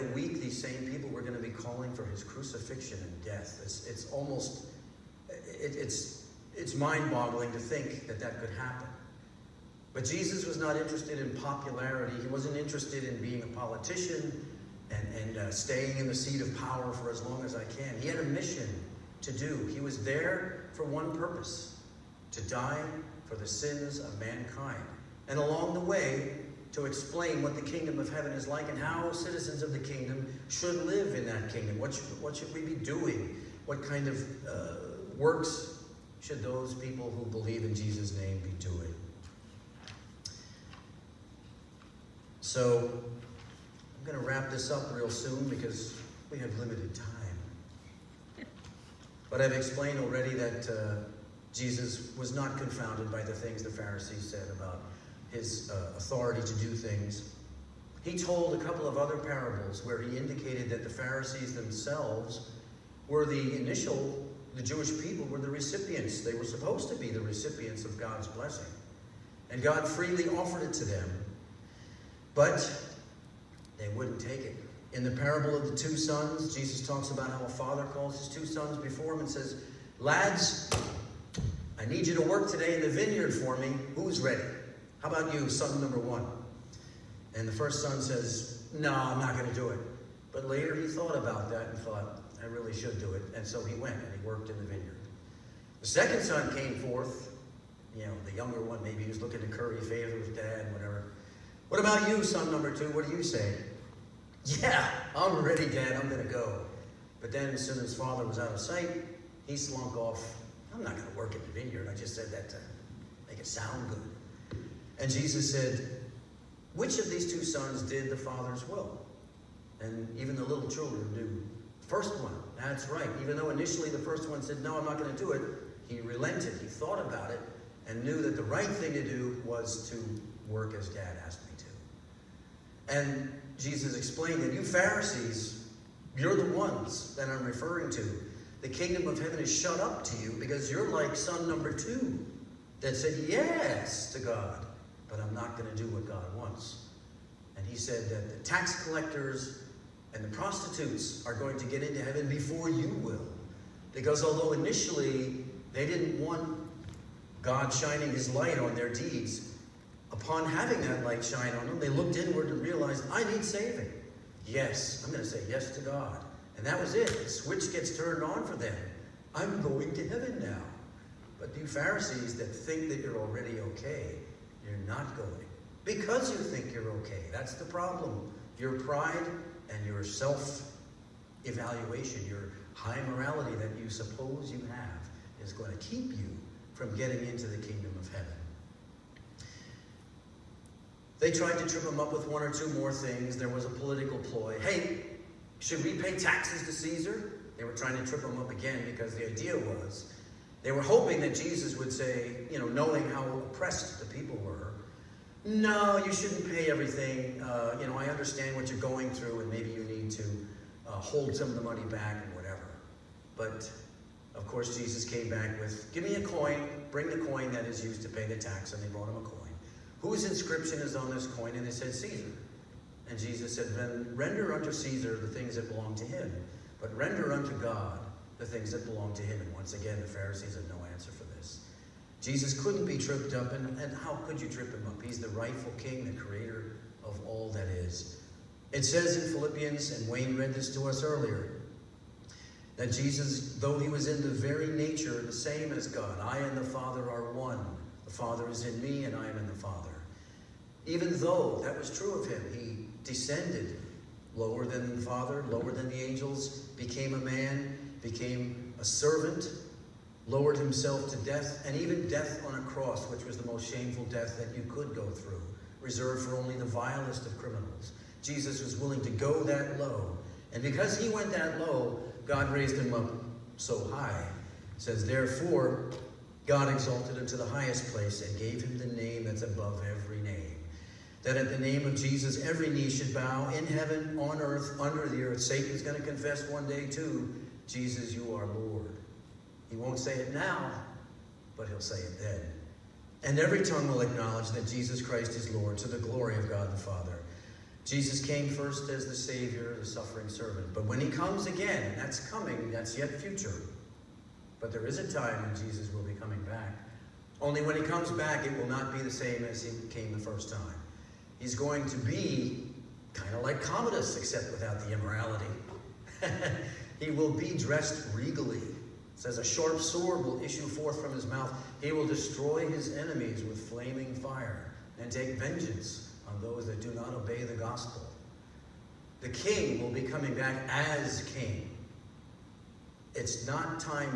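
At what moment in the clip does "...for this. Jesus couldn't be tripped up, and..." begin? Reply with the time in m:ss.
3:51.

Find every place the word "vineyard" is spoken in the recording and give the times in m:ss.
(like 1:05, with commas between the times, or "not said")
1:22, 1:34, 1:51.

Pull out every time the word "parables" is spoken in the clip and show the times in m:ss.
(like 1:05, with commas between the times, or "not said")
0:59, 1:15.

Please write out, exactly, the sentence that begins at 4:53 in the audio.
And every tongue will acknowledge that Jesus Christ is Lord to the glory of God the Father.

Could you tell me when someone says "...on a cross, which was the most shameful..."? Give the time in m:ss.
4:22.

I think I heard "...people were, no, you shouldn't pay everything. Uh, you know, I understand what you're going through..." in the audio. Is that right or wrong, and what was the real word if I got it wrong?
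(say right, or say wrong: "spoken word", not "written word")
right.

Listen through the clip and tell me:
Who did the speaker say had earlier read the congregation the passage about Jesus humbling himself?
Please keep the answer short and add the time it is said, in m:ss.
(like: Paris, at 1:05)
Wayne, at 4:00.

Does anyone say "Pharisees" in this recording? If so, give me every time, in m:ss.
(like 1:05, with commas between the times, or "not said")
0:53, 1:00, 2:14, 2:51, 3:50.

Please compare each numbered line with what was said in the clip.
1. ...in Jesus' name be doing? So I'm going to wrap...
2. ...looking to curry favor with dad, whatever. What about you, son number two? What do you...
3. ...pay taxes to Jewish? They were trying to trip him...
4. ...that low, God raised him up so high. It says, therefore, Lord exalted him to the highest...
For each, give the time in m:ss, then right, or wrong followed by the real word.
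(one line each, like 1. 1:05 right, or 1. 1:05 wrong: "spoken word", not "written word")
1. 0:37 right
2. 1:39 right
3. 3:15 wrong: "Caesar", not "Jewish"
4. 4:31 wrong: "God", not "Lord".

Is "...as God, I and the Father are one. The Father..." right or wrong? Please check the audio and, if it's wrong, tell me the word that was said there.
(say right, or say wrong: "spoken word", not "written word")
right.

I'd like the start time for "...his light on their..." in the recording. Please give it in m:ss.
2:38.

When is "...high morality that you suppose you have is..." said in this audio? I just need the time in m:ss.
3:02.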